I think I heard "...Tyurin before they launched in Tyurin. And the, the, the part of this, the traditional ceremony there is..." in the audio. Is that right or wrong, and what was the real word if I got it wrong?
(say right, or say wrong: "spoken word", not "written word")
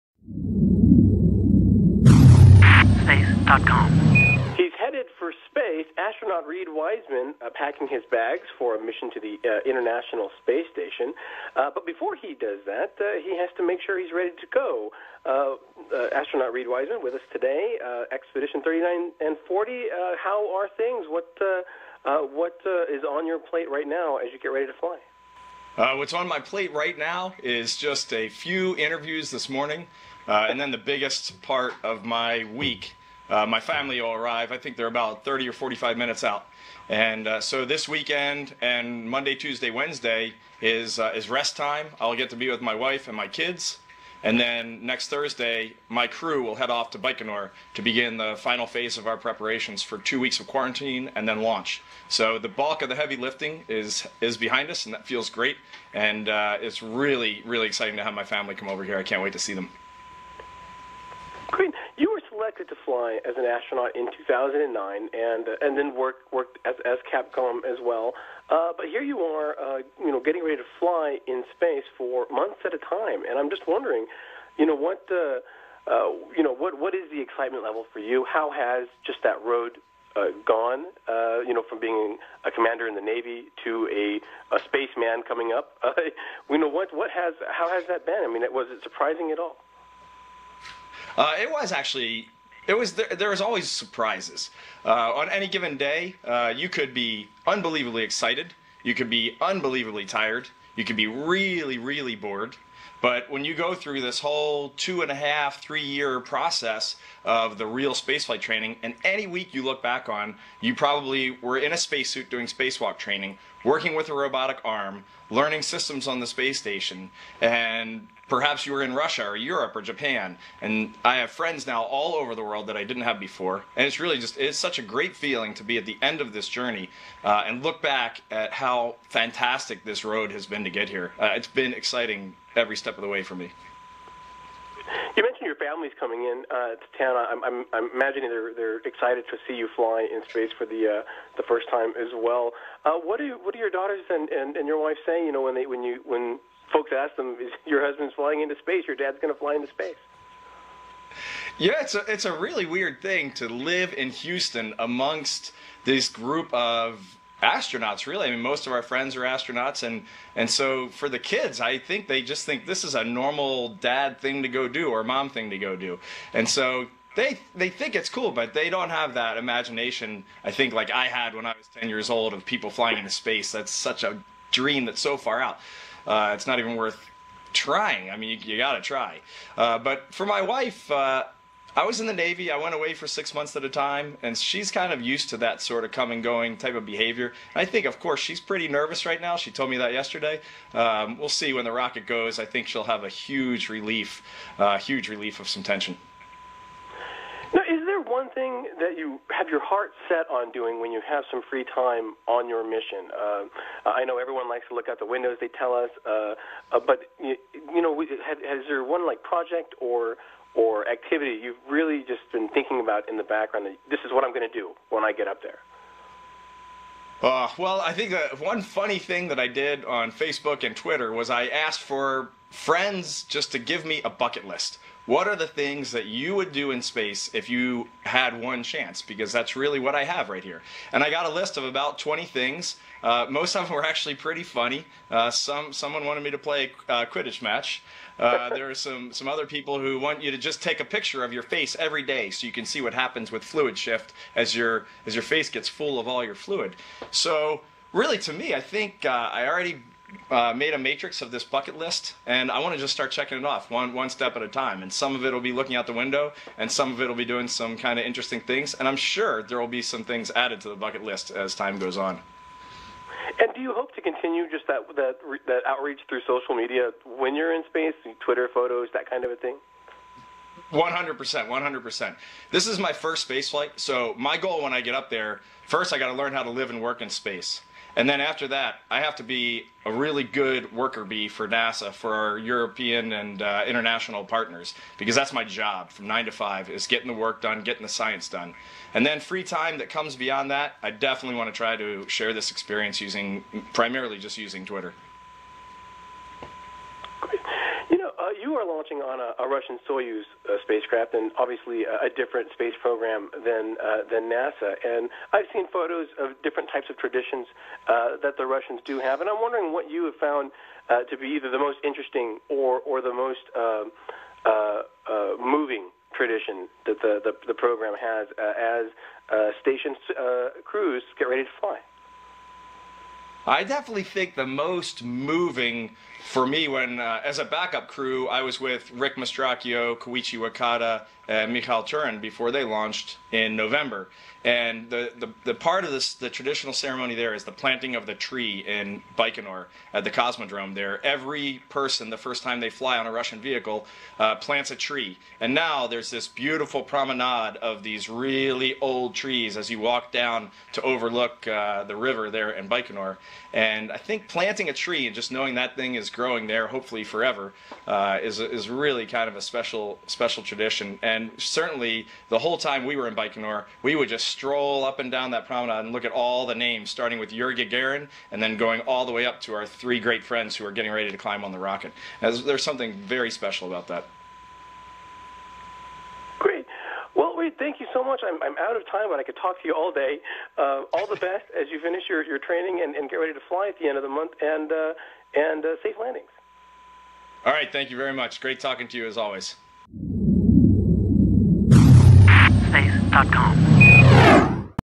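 wrong: "November", not "Tyurin".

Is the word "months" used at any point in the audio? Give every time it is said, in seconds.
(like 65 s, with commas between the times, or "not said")
72 s, 183 s, 384 s.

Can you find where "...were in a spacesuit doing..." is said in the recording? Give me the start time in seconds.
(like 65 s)
111 s.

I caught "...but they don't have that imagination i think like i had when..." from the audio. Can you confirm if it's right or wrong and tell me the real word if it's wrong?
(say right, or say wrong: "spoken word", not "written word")
right.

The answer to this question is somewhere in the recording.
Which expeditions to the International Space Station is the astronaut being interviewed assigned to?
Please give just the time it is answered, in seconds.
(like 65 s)
18 s.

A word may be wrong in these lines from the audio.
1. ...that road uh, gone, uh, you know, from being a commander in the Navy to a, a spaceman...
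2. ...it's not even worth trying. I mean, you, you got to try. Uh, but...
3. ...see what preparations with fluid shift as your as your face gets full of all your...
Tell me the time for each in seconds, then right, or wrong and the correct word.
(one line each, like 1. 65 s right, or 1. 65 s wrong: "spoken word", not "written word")
1. 79 s right
2. 176 s right
3. 242 s wrong: "happens", not "preparations".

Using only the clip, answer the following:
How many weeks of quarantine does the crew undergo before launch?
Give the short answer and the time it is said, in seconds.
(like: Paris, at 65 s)
2, at 49 s.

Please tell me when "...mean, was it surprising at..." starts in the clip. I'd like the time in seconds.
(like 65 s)
88 s.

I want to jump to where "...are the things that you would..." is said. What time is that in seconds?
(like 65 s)
225 s.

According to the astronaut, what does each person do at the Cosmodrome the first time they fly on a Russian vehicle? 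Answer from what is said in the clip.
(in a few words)
plants a tree.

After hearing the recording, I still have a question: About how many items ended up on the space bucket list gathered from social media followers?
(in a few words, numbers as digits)
20.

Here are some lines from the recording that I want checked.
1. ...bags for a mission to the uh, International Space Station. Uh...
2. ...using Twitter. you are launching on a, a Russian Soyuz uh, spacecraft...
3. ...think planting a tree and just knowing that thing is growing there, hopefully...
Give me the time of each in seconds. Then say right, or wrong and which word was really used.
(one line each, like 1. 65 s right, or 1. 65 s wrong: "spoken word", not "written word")
1. 8 s right
2. 294 s right
3. 353 s right.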